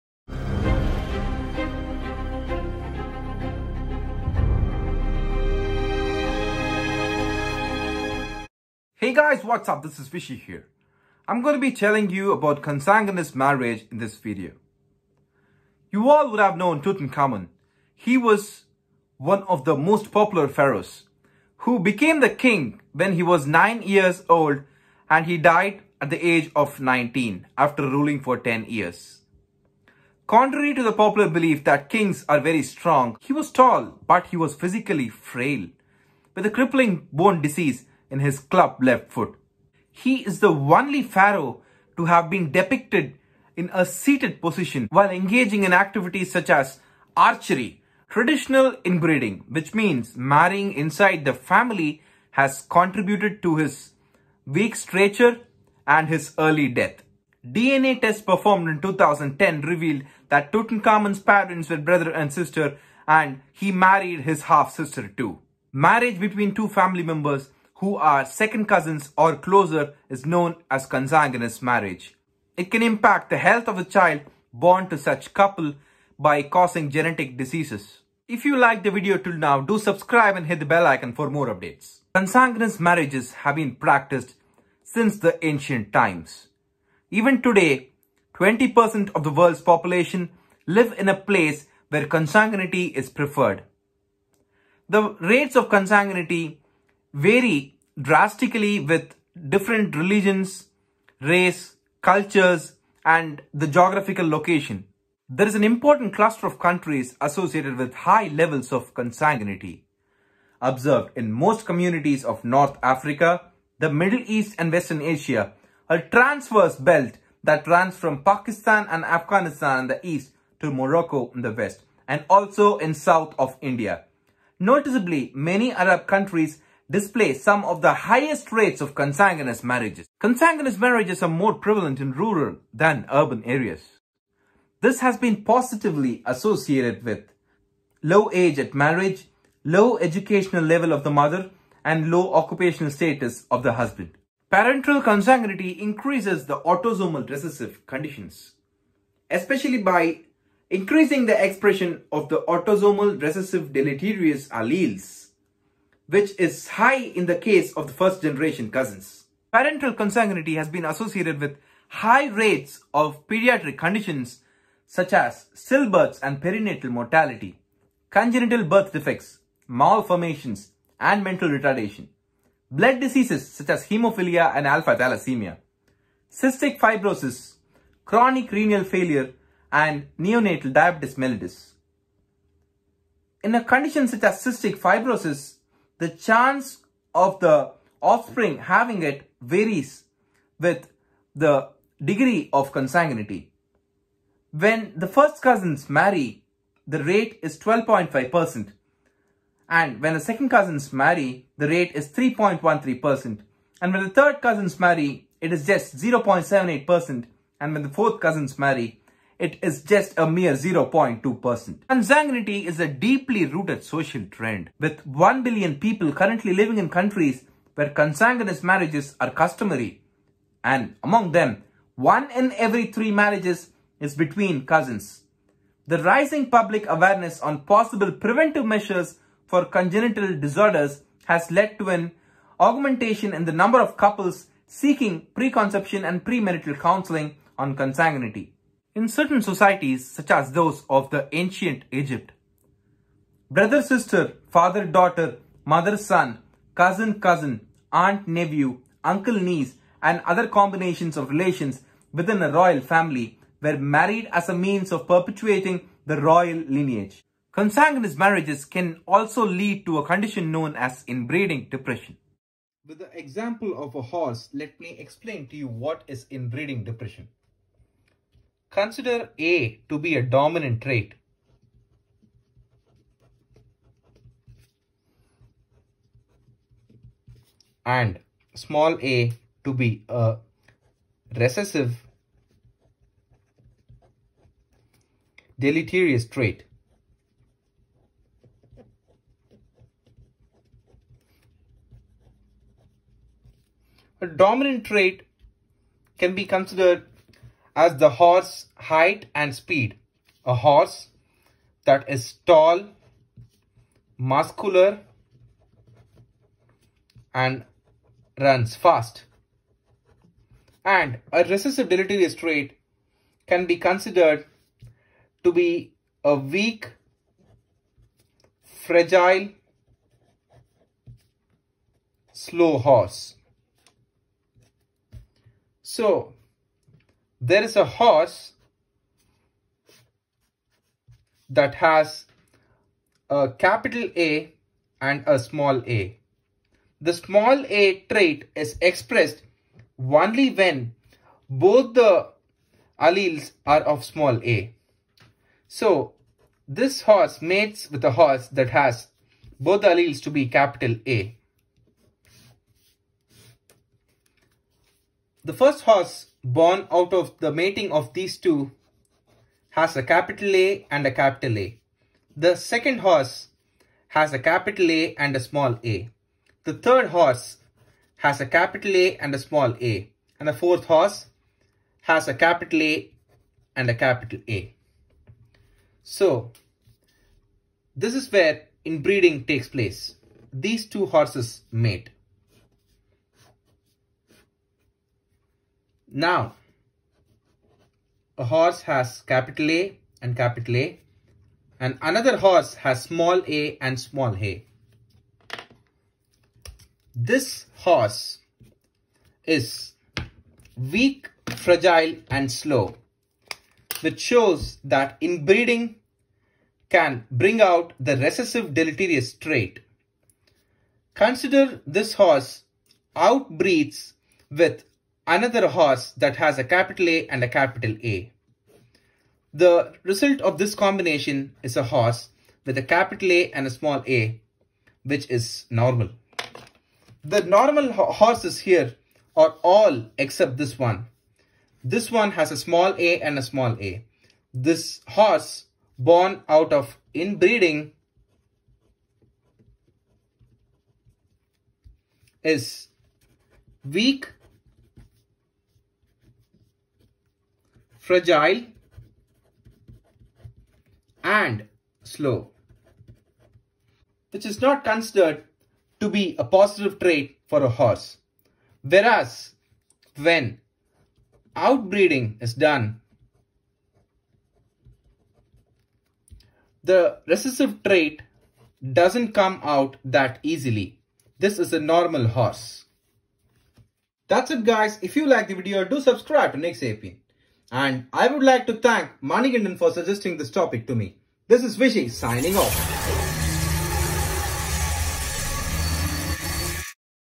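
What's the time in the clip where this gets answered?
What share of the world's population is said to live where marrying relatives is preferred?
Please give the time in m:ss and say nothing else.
1:28.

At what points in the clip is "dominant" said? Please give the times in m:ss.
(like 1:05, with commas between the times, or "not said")
4:30, 4:54.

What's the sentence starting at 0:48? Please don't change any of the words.
Traditional inbreeding, which means marrying inside the family, has contributed to his weak stature and his early death.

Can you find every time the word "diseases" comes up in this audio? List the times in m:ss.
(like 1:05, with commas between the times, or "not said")
0:37, 1:17, 2:52.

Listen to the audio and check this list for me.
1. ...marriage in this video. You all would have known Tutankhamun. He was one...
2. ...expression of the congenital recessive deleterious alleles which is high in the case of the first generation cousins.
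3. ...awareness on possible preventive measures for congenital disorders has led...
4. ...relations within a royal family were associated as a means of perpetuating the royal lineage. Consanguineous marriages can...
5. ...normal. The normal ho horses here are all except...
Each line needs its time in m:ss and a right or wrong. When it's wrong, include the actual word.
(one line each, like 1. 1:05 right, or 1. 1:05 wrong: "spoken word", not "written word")
1. 0:13 right
2. 2:31 wrong: "autosomal", not "congenital"
3. 3:46 right
4. 4:11 wrong: "married", not "associated"
5. 7:05 right.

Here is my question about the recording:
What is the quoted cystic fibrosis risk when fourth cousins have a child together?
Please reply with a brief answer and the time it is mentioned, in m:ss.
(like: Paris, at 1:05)
0.2%, at 3:30.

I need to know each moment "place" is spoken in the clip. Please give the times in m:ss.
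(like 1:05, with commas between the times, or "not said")
1:31, 6:19.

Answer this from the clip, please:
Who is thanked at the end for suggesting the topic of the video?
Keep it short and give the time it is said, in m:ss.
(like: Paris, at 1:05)
Manigandan, at 7:59.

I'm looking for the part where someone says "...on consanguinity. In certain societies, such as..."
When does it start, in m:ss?
3:57.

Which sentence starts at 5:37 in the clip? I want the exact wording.
The small a trait is expressed only when both the alleles are of small a.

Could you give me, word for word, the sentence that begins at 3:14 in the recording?
When the first cousins marry, the rate is 12.5%.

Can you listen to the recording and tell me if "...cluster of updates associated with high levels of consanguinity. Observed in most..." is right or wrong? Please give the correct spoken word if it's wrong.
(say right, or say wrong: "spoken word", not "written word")
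wrong: "countries", not "updates".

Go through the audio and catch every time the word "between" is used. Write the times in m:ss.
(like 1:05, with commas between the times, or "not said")
1:06, 3:44.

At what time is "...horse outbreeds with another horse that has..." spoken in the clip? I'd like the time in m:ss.
6:52.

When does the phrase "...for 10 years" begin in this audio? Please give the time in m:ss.
0:28.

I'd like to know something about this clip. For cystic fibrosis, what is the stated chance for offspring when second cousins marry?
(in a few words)
3.13%.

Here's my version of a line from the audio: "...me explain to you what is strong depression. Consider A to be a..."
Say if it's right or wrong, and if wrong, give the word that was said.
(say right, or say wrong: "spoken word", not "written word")
wrong: "inbreeding", not "strong".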